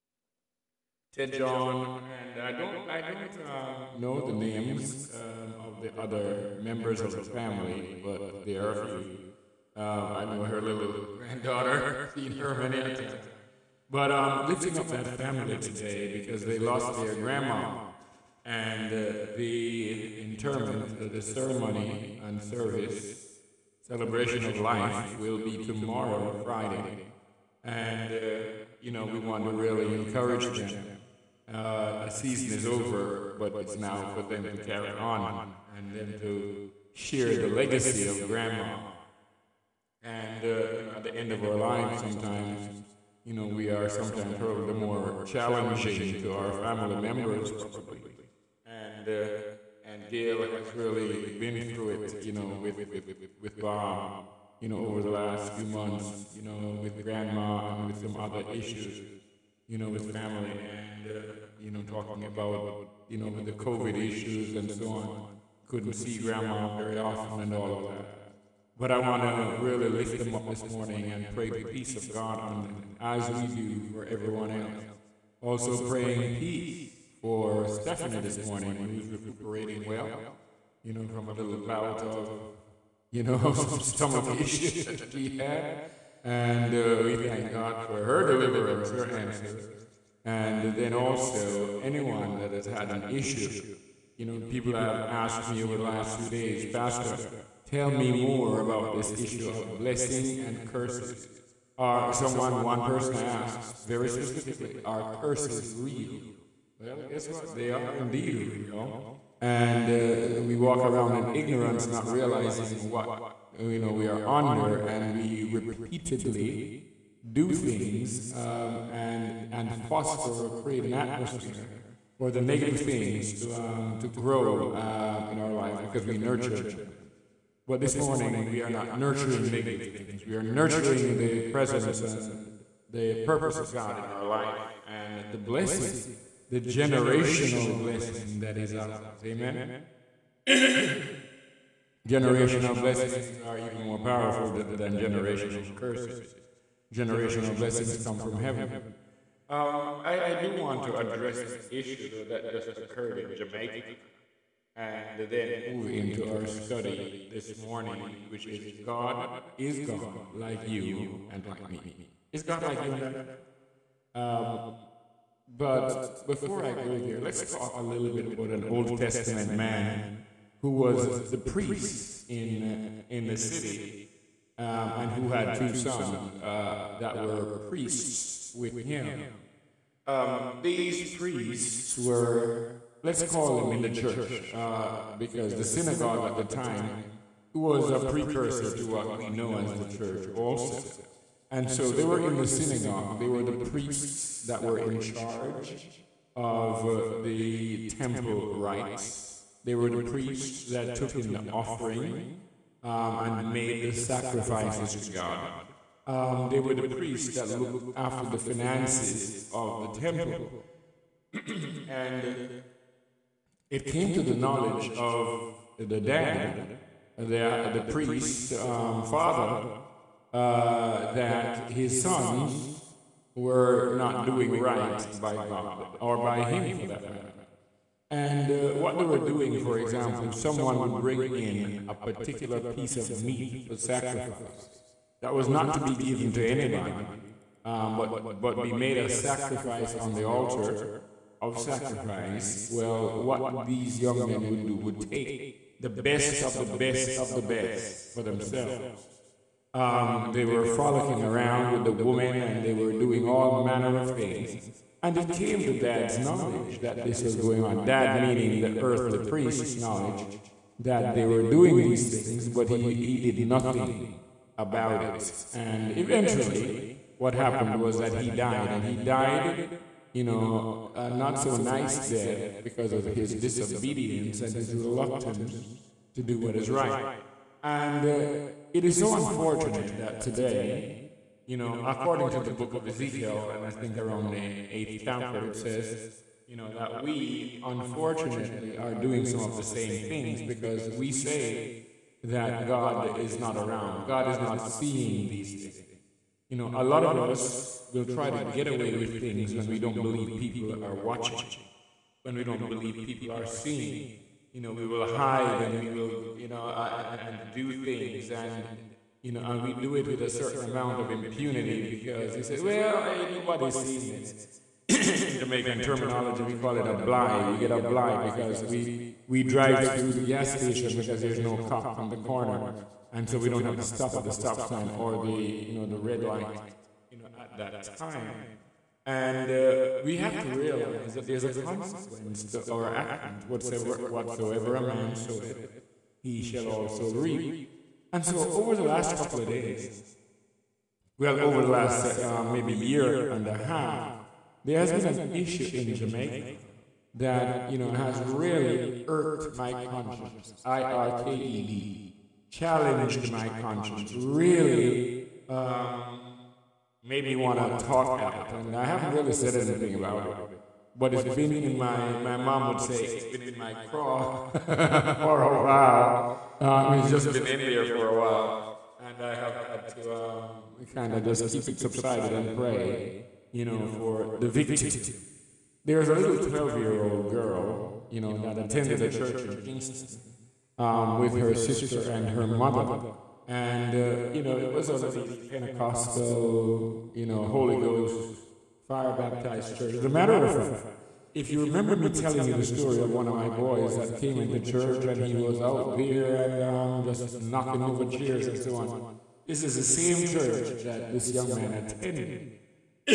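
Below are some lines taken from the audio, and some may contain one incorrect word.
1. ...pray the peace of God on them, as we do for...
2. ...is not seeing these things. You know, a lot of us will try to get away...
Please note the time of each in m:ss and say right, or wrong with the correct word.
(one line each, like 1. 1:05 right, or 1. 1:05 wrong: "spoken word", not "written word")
1. 1:11 right
2. 4:54 right.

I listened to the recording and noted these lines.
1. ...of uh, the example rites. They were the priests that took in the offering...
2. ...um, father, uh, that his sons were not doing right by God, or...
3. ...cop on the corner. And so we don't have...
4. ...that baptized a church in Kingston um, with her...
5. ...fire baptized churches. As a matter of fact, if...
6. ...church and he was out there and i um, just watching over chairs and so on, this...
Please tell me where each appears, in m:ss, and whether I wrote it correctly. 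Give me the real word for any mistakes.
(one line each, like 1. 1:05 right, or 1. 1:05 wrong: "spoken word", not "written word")
1. 3:16 wrong: "temple", not "example"
2. 3:38 right
3. 5:21 right
4. 6:18 wrong: "attended", not "baptized"
5. 6:28 right
6. 6:34 wrong: "knocking", not "watching".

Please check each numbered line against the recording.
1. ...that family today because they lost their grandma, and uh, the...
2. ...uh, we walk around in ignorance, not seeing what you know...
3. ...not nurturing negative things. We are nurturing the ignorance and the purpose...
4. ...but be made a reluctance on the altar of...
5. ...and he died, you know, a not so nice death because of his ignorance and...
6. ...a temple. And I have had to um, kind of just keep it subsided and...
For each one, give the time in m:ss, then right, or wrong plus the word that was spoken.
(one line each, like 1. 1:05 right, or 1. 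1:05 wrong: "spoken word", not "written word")
1. 0:14 right
2. 1:49 wrong: "realizing", not "seeing"
3. 2:08 wrong: "presence", not "ignorance"
4. 3:58 wrong: "sacrifice", not "reluctance"
5. 4:28 wrong: "disobedience", not "ignorance"
6. 6:08 wrong: "while", not "temple".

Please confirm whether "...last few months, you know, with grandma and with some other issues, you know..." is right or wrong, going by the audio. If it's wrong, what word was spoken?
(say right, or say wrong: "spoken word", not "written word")
right.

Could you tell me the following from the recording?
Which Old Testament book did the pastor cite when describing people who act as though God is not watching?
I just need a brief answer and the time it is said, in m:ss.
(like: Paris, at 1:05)
Ezekiel, at 4:42.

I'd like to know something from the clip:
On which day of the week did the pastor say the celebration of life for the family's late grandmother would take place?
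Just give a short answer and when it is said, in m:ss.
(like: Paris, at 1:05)
Friday, at 0:26.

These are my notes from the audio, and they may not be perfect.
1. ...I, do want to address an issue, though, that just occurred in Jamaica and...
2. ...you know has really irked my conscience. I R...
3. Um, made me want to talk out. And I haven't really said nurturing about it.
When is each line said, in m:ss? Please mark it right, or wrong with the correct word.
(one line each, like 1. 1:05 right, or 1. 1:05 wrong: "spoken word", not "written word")
1. 2:30 right
2. 5:47 right
3. 5:55 wrong: "anything", not "nurturing".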